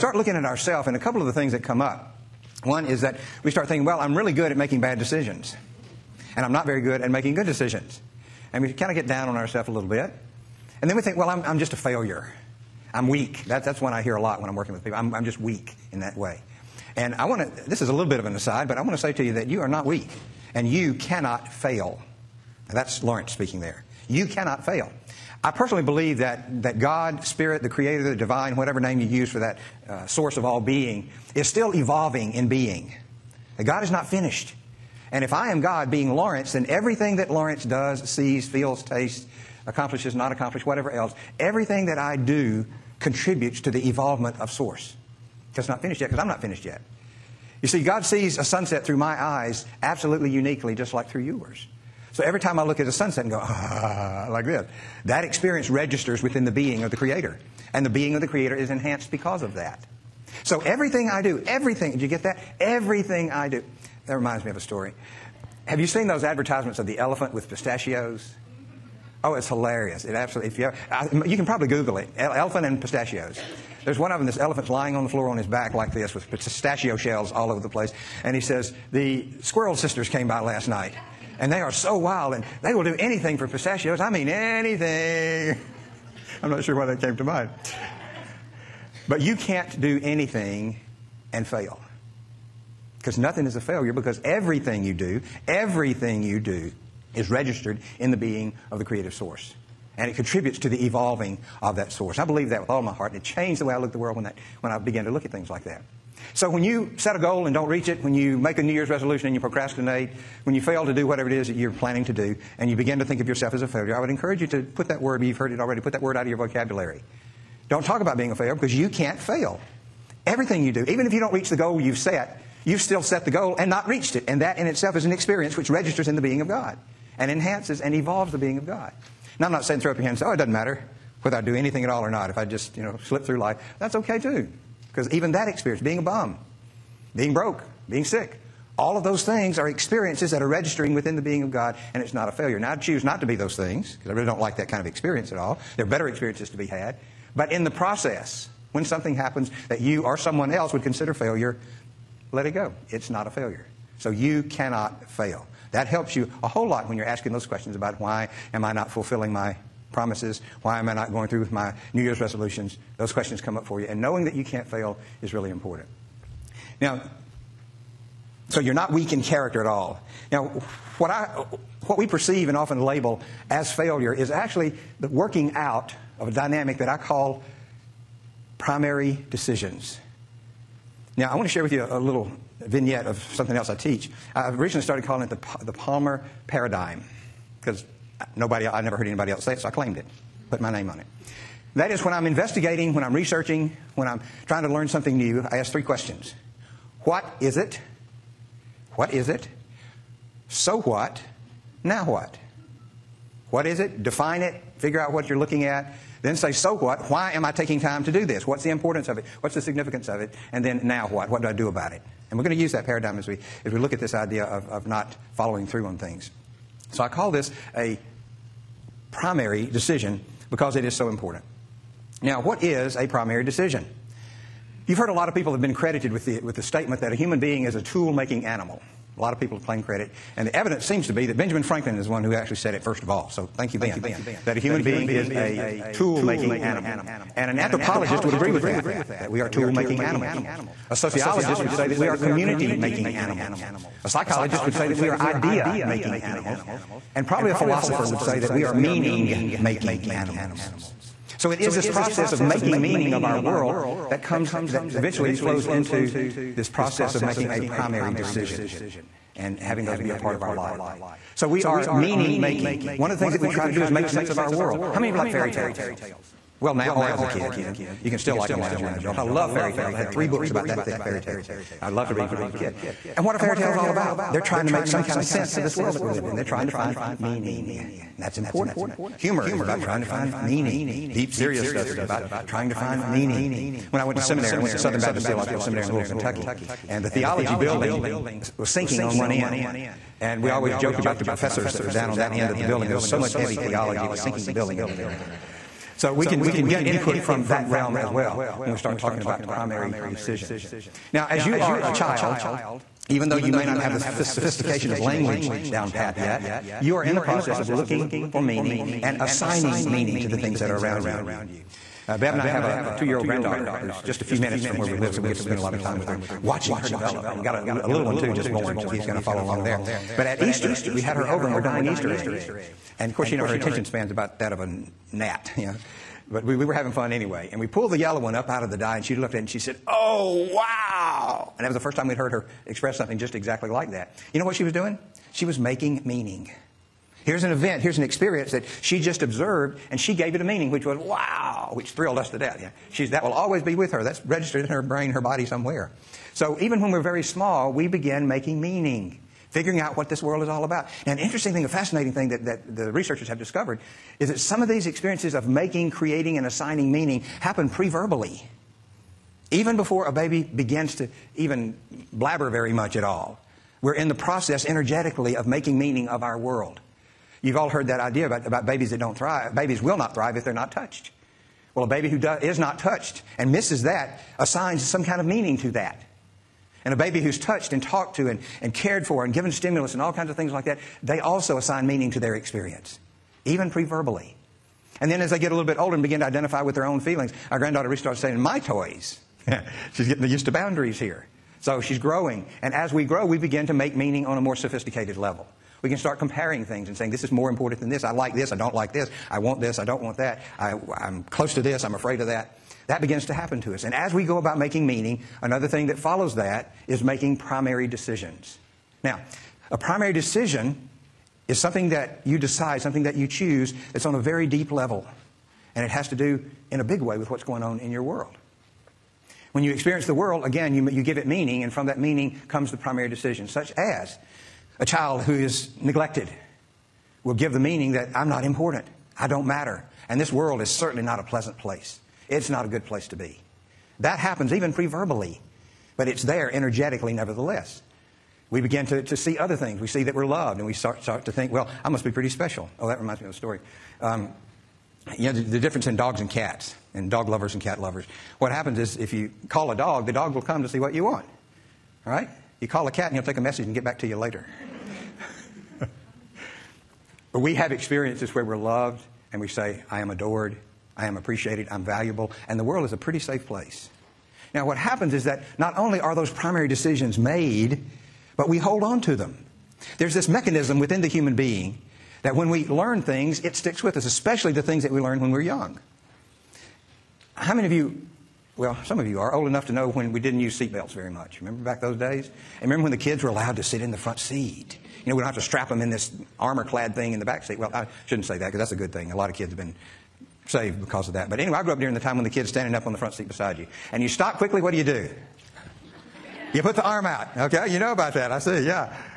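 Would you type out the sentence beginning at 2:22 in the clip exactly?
Now, I choose not to be those things because I really don't like that kind of experience at all.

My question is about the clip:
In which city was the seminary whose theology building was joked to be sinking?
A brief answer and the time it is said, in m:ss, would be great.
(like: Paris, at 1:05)
Louisville, Kentucky, at 4:45.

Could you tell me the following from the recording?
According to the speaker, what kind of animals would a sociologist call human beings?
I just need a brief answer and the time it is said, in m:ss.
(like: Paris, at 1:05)
community making animals, at 4:02.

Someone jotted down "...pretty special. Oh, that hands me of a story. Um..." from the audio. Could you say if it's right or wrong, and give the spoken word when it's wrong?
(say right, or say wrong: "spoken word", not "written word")
wrong: "reminds", not "hands".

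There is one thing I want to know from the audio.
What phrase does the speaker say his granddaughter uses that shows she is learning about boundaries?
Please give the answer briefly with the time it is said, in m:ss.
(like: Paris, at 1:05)
My toys, at 6:28.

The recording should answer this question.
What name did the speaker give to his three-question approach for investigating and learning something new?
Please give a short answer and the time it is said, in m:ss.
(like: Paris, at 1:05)
the Palmer paradigm, at 3:05.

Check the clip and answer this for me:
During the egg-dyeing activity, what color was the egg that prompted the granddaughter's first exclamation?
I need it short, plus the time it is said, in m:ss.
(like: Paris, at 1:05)
yellow, at 5:27.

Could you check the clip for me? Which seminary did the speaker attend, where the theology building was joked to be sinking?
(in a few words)
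Southern Baptist Theological Seminary.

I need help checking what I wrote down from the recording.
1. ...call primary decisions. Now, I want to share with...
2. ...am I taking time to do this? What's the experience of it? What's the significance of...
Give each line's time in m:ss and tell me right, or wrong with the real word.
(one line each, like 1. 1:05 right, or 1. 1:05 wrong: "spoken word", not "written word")
1. 2:56 right
2. 3:27 wrong: "importance", not "experience".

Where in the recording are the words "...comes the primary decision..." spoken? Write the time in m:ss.
7:02.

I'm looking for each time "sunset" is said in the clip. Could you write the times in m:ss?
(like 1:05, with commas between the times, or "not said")
0:48, 0:52.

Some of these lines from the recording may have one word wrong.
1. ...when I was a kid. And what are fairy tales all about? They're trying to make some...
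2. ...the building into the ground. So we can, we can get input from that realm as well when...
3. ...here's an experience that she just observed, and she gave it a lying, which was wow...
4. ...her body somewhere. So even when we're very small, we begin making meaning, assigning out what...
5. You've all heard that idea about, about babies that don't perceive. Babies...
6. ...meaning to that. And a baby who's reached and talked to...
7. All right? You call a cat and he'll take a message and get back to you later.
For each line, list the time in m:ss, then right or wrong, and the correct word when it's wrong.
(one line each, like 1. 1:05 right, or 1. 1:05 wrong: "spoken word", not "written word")
1. 4:32 right
2. 4:54 right
3. 5:37 wrong: "meaning", not "lying"
4. 5:45 wrong: "figuring", not "assigning"
5. 6:07 wrong: "thrive", not "perceive"
6. 6:15 wrong: "touched", not "reached"
7. 7:32 right.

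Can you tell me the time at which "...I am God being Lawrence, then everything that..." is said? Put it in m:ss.
0:35.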